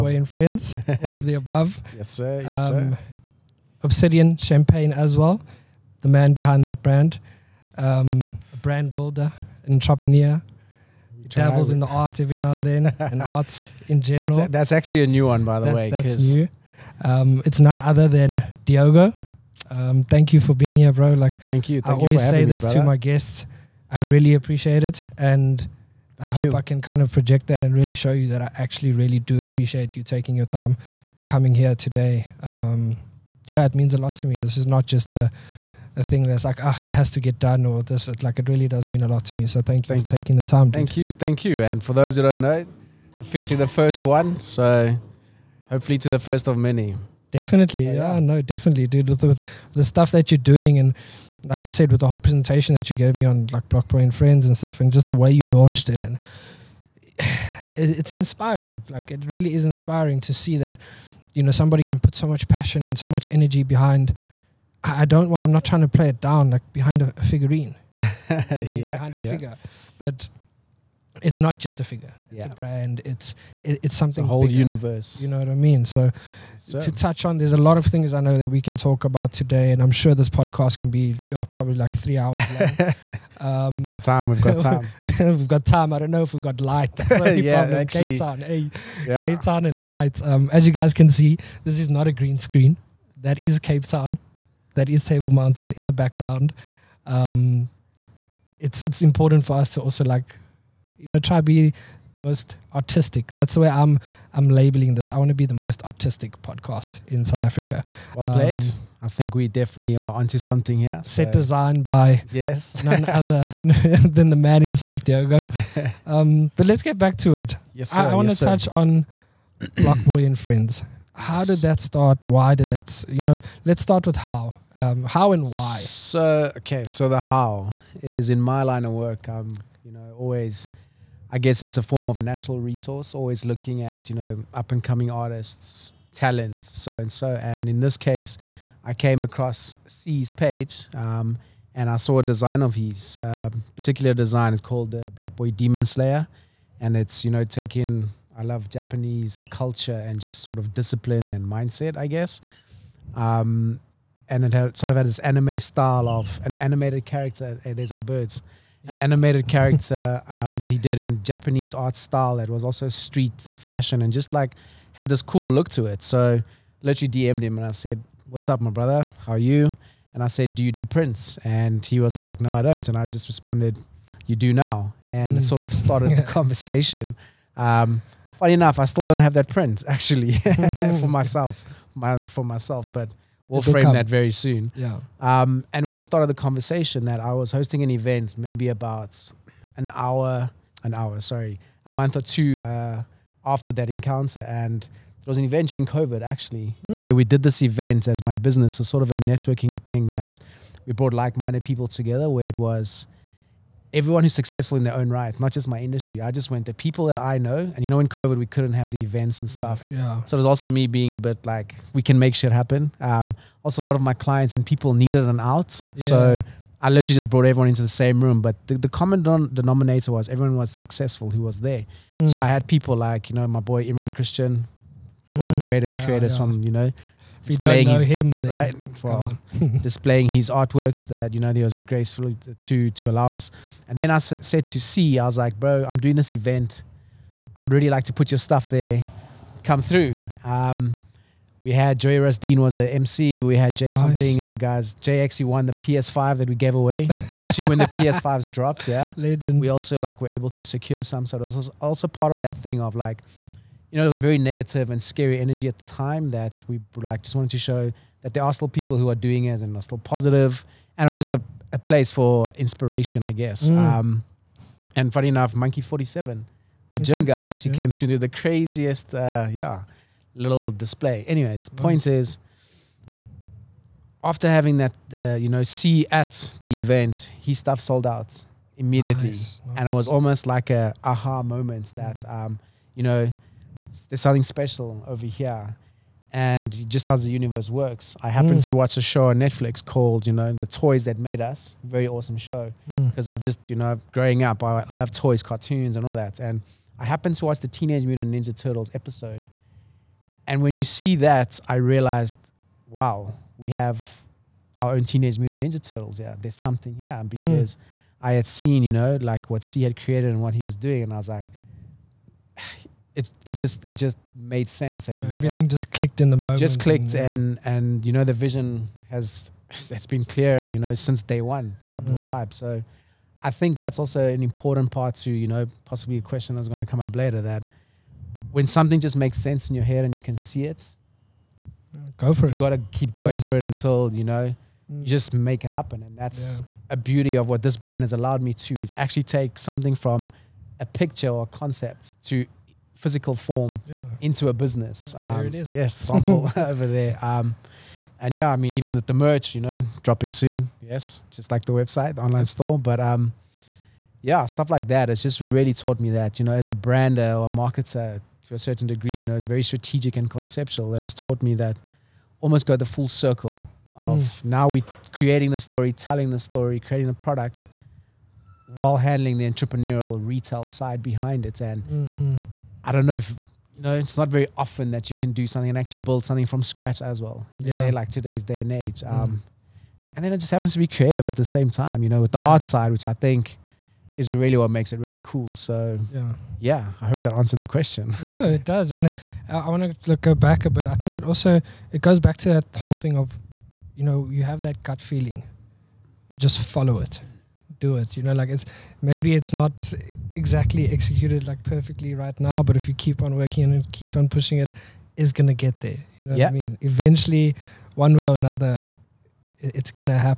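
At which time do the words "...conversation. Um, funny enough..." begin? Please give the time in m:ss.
2:56.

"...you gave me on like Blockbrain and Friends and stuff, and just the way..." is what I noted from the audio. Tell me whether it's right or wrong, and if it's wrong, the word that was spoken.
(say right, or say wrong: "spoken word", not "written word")
right.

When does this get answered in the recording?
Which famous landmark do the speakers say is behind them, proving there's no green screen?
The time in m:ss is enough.
1:35.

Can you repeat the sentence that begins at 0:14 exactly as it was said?
That's, that's, actually a new one, by the that, way.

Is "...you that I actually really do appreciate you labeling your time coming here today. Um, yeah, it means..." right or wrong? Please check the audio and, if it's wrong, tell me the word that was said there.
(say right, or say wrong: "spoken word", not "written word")
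wrong: "taking", not "labeling".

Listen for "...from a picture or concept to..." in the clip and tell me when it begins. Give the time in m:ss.
5:39.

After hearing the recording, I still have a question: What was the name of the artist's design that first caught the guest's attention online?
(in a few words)
Black Boy Demon Slayer.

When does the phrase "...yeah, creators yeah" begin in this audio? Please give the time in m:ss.
3:45.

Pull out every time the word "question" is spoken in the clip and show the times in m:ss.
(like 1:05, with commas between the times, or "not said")
5:26, 6:27.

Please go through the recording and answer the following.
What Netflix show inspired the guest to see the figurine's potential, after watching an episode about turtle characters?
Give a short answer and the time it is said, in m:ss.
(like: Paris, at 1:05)
The Toys That Made Us, at 4:50.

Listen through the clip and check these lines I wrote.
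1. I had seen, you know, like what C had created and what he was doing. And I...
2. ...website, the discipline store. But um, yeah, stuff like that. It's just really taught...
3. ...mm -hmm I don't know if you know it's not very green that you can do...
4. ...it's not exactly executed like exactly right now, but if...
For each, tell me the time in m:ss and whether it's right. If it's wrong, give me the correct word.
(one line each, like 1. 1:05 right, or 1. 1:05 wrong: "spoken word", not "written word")
1. 5:08 right
2. 5:51 wrong: "online", not "discipline"
3. 6:11 wrong: "often", not "green"
4. 6:39 wrong: "perfectly", not "exactly".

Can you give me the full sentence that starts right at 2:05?
So okay, so the how is in my line of work.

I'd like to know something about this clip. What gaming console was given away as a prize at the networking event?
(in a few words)
PS5.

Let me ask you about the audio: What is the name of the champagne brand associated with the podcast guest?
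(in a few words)
Obsidian Champagne.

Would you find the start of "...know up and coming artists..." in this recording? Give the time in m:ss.
2:14.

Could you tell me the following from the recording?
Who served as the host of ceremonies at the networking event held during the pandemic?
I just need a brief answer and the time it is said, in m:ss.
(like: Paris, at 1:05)
Joey Dean, at 4:01.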